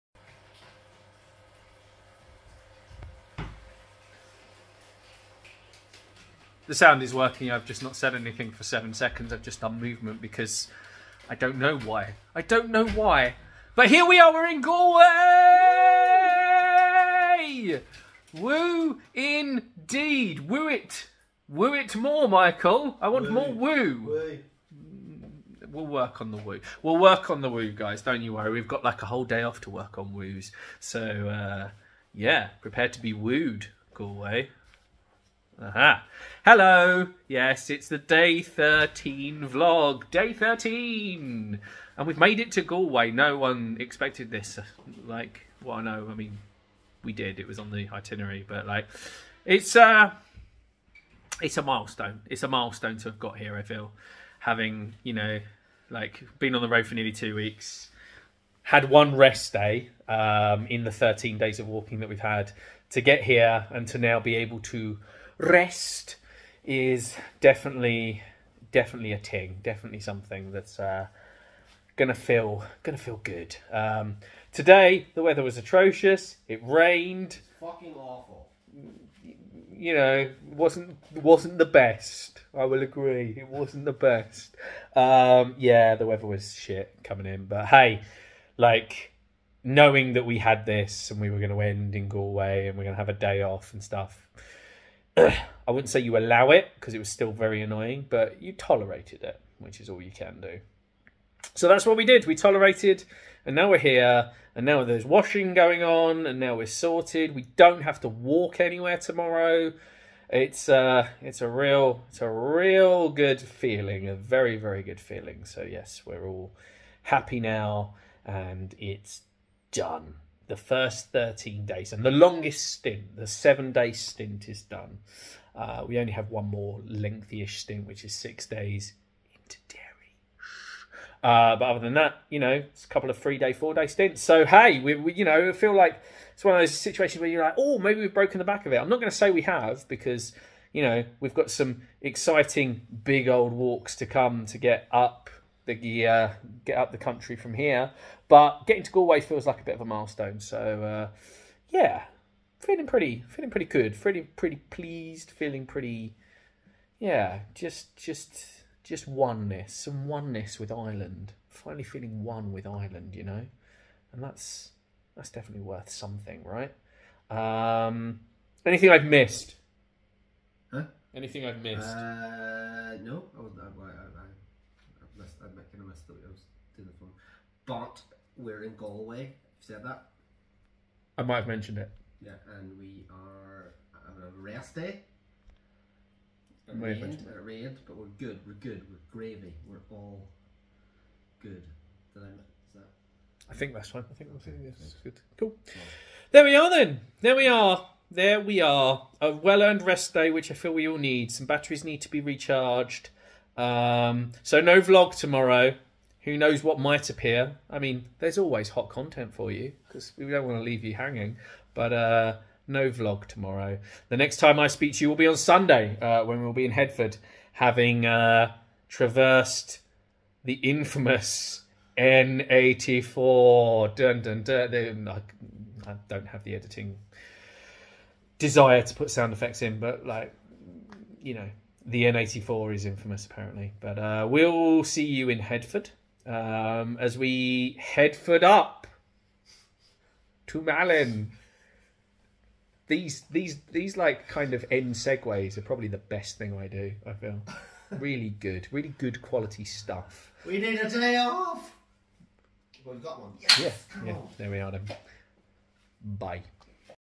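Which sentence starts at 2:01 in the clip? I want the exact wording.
And the longest stint, the seven day stint, is done.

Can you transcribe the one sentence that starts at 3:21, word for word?
Some batteries need to be recharged.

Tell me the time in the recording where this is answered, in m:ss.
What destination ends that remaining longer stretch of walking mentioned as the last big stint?
2:09.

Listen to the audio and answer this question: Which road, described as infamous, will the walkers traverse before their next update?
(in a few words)
N84.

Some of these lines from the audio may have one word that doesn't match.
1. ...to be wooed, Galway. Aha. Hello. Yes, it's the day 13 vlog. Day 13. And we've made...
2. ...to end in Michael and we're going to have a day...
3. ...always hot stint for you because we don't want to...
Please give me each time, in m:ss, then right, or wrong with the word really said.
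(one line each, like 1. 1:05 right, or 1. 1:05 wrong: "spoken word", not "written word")
1. 0:32 right
2. 1:31 wrong: "Galway", not "Michael"
3. 3:28 wrong: "content", not "stint".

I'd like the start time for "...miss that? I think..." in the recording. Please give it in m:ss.
3:12.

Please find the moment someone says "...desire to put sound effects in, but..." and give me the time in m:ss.
3:48.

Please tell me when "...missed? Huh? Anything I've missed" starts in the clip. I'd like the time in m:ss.
2:49.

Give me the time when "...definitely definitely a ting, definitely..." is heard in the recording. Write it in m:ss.
1:07.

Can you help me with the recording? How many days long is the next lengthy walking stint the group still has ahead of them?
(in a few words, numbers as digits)
six days.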